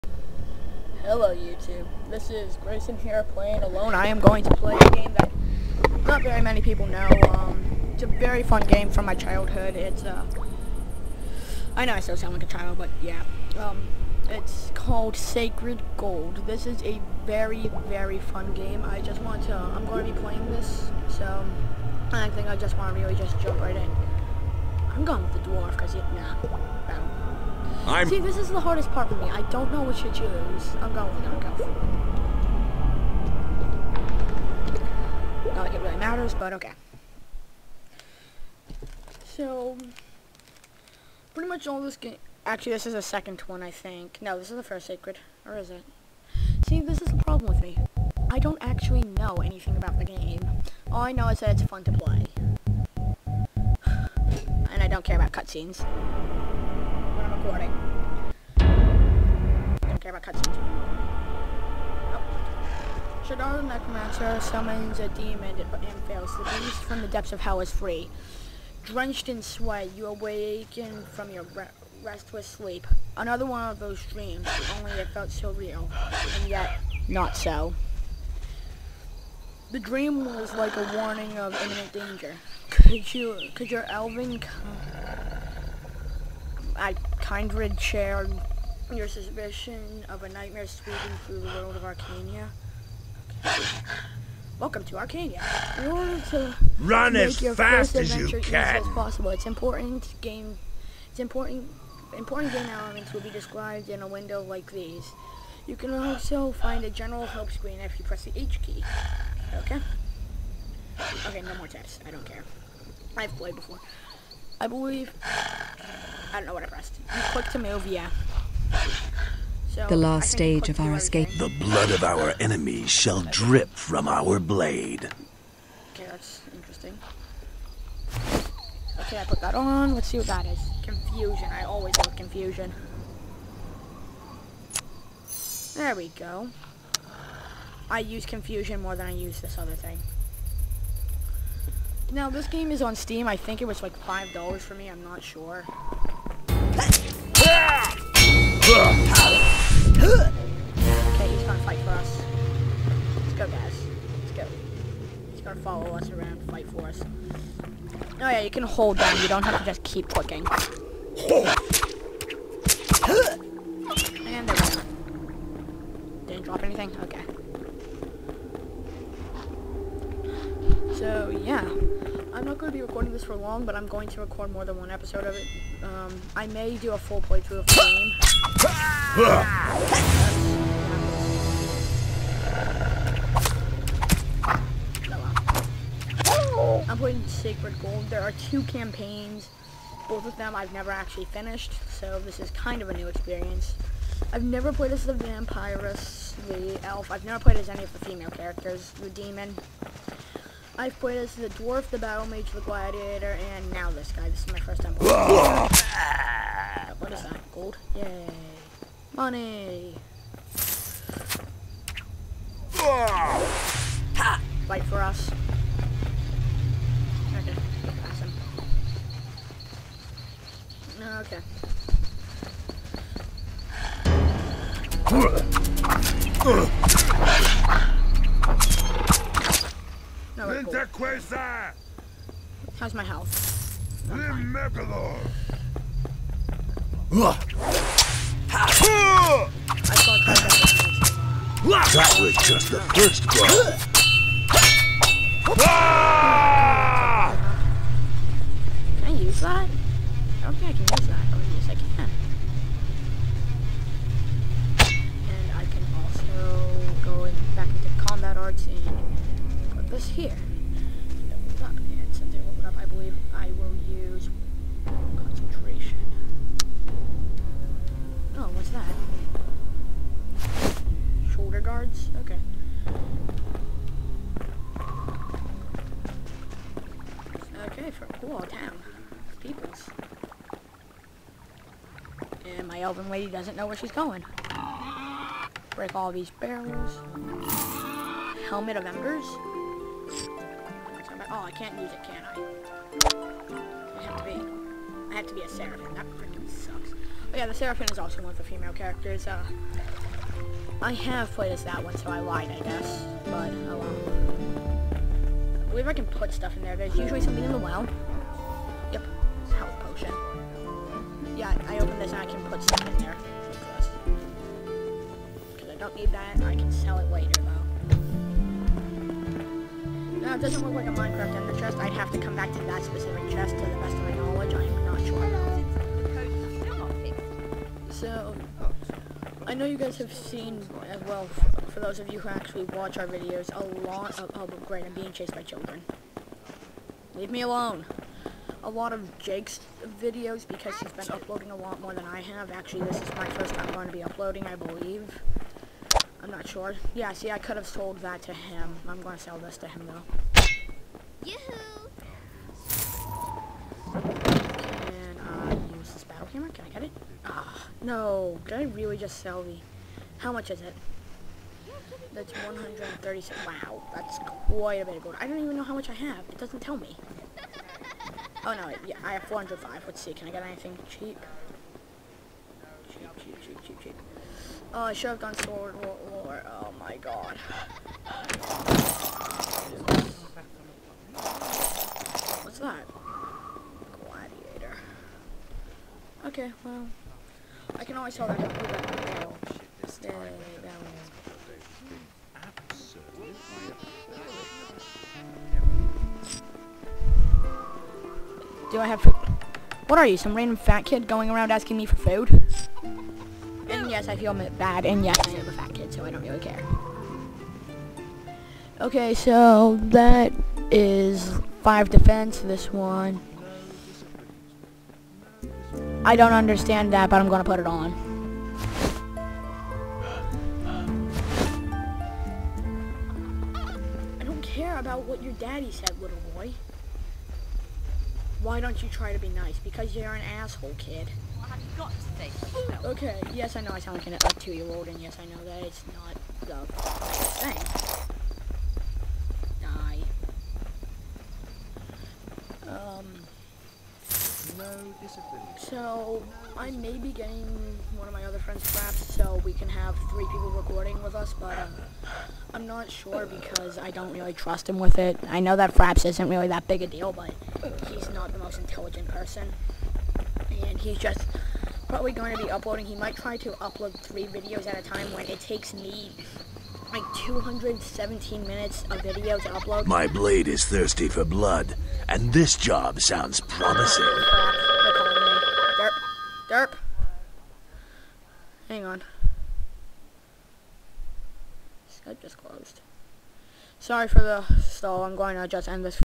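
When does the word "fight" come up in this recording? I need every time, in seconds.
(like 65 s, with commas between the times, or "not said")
151 s, 156 s, 214 s.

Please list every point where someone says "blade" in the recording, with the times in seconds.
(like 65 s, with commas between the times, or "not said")
124 s, 470 s.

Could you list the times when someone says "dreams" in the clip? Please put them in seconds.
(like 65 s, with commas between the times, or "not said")
74 s, 79 s.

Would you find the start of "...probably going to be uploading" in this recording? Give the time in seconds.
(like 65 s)
461 s.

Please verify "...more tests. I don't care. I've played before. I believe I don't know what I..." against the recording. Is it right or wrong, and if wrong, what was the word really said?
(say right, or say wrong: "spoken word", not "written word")
right.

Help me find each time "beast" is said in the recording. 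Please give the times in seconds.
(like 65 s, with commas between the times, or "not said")
66 s.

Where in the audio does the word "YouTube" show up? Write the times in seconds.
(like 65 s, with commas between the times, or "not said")
1 s.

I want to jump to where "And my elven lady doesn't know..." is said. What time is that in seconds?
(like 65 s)
282 s.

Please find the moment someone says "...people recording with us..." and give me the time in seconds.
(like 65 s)
450 s.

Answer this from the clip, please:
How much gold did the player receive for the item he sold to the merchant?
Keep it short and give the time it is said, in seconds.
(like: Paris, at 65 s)
136, at 362 s.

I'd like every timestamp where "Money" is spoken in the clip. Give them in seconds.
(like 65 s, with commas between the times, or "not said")
209 s.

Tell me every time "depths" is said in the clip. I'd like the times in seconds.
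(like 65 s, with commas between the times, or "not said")
67 s.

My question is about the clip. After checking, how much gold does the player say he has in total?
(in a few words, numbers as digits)
405.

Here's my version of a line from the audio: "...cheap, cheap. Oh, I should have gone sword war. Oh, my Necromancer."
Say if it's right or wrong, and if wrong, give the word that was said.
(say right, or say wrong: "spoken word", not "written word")
wrong: "God", not "Necromancer".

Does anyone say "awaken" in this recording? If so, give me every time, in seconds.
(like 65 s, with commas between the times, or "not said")
70 s.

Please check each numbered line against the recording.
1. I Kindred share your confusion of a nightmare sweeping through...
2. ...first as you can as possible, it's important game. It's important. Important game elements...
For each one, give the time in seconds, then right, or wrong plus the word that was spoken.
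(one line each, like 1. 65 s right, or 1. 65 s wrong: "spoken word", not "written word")
1. 86 s wrong: "suspicion", not "confusion"
2. 97 s right.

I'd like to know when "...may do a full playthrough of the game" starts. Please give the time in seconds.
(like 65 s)
176 s.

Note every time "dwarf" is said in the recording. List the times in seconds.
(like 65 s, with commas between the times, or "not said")
25 s, 201 s.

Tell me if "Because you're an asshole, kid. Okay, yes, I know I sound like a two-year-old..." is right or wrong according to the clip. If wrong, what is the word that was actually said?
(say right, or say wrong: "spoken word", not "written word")
right.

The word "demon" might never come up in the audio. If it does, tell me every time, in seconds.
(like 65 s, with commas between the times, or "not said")
65 s, 199 s.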